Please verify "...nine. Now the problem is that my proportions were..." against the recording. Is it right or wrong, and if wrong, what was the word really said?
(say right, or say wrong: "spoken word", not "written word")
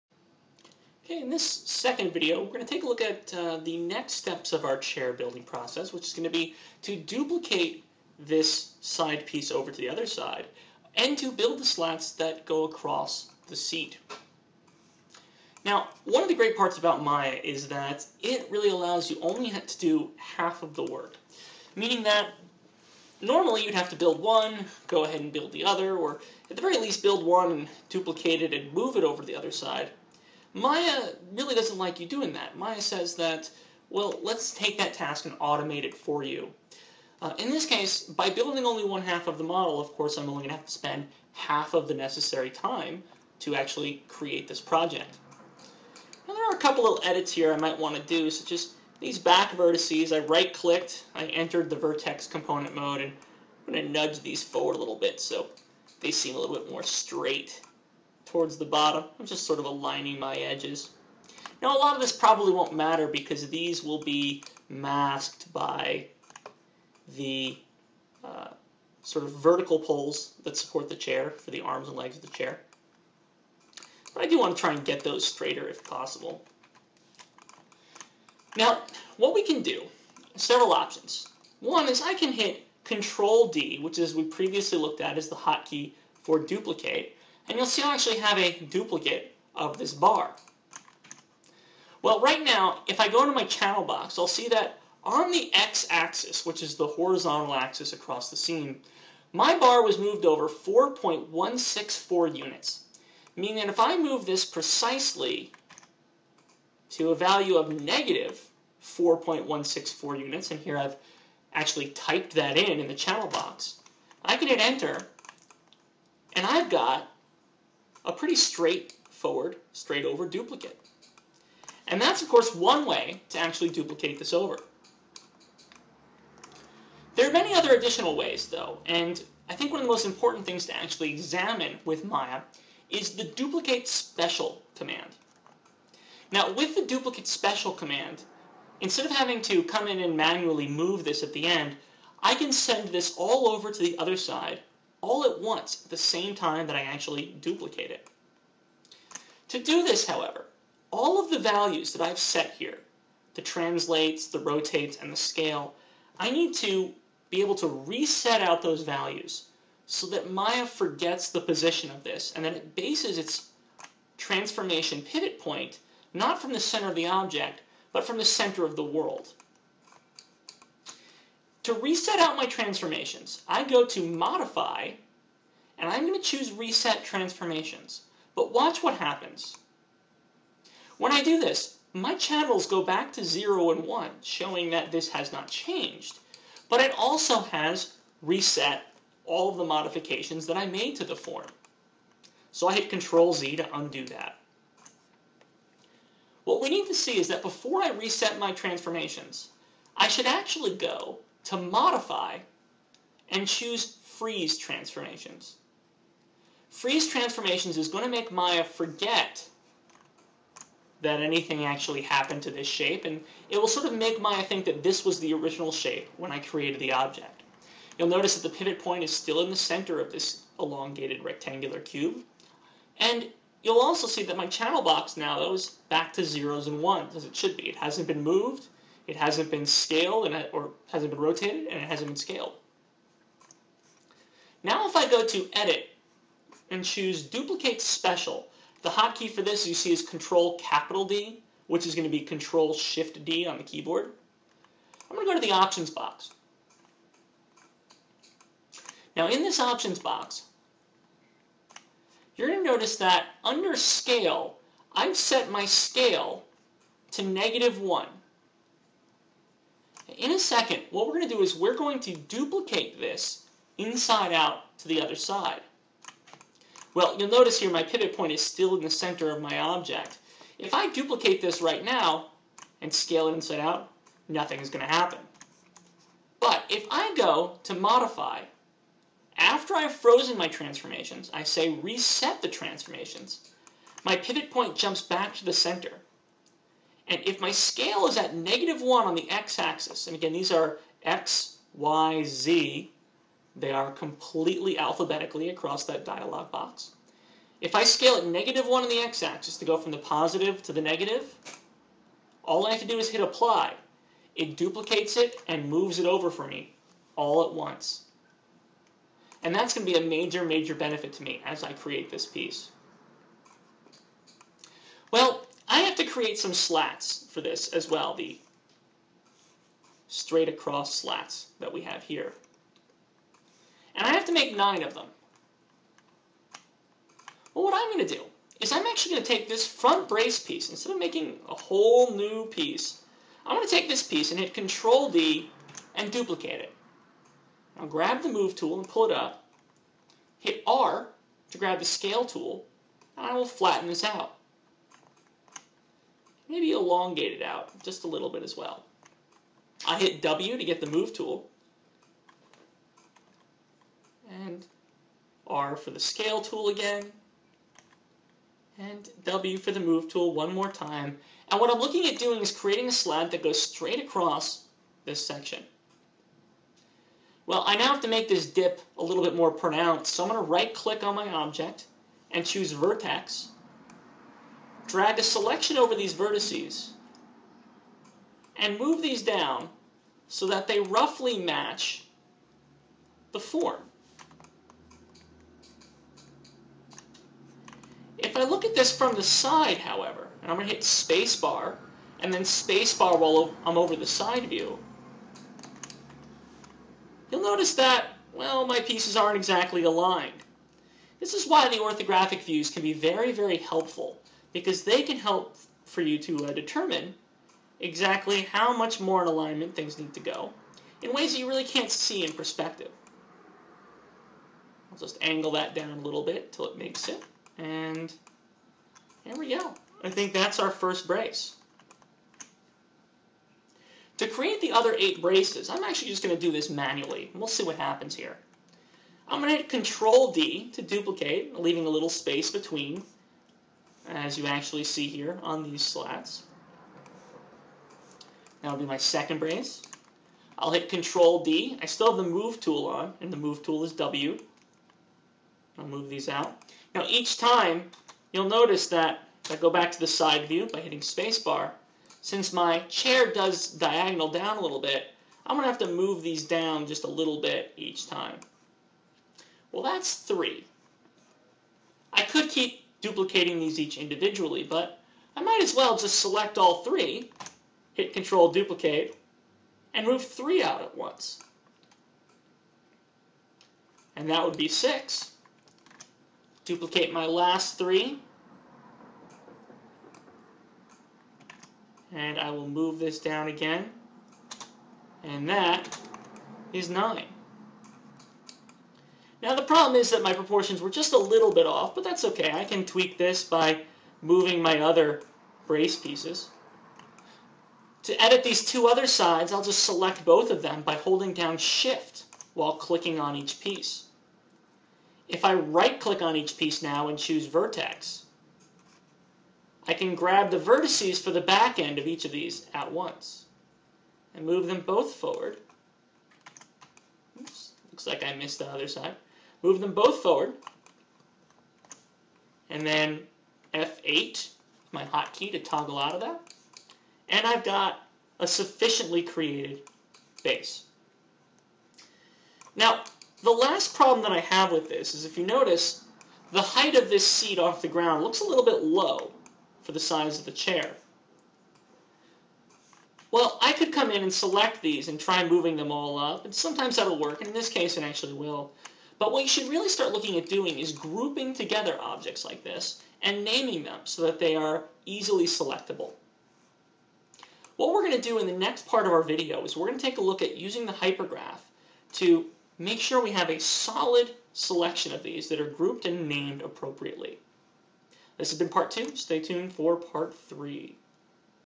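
right.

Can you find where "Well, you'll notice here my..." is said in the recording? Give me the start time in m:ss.
4:26.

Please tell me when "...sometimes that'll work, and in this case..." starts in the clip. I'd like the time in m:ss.
9:06.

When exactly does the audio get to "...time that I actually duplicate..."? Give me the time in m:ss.
2:26.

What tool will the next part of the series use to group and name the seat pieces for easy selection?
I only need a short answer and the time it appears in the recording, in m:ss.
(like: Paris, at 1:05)
hypergraph, at 9:20.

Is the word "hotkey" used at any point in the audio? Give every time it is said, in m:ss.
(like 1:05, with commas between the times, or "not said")
1:25, 3:58, 8:45.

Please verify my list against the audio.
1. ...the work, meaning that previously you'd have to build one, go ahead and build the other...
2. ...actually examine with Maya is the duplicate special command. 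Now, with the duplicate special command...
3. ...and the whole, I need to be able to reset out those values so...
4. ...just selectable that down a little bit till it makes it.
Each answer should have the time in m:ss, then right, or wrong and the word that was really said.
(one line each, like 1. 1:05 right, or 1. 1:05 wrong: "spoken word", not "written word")
1. 0:20 wrong: "normally", not "previously"
2. 2:10 right
3. 2:35 wrong: "scale", not "whole"
4. 6:54 wrong: "angle", not "selectable".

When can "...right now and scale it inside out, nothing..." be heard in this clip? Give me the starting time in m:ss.
4:31.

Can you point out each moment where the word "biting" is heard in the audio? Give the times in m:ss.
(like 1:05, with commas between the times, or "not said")
not said.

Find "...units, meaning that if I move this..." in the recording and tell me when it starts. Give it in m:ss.
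1:42.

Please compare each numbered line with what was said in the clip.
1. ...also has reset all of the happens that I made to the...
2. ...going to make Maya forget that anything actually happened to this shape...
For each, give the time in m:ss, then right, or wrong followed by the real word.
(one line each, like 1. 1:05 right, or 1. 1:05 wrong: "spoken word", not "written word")
1. 3:06 wrong: "modifications", not "happens"
2. 3:27 right.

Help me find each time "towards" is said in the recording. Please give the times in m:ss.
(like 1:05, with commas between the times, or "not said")
0:58.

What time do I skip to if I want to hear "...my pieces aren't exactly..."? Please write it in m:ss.
6:38.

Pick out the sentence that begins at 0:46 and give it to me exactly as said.
Now, there are a couple little edits here I might want to do, such as these back vertices.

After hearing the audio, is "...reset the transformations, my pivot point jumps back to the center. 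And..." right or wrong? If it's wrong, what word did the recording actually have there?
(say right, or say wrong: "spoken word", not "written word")
right.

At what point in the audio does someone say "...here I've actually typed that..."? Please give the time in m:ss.
1:50.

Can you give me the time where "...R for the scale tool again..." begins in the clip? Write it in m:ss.
5:55.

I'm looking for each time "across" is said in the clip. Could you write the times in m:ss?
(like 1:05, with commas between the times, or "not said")
0:12, 1:37, 4:55, 5:20, 6:04.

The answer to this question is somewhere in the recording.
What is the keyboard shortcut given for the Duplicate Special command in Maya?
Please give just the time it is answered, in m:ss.
4:02.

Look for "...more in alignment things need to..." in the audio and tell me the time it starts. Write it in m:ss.
6:48.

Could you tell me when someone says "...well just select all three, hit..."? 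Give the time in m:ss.
7:45.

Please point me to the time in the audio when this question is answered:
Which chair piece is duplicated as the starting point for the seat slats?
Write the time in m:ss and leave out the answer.
5:29.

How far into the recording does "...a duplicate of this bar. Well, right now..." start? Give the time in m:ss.
1:28.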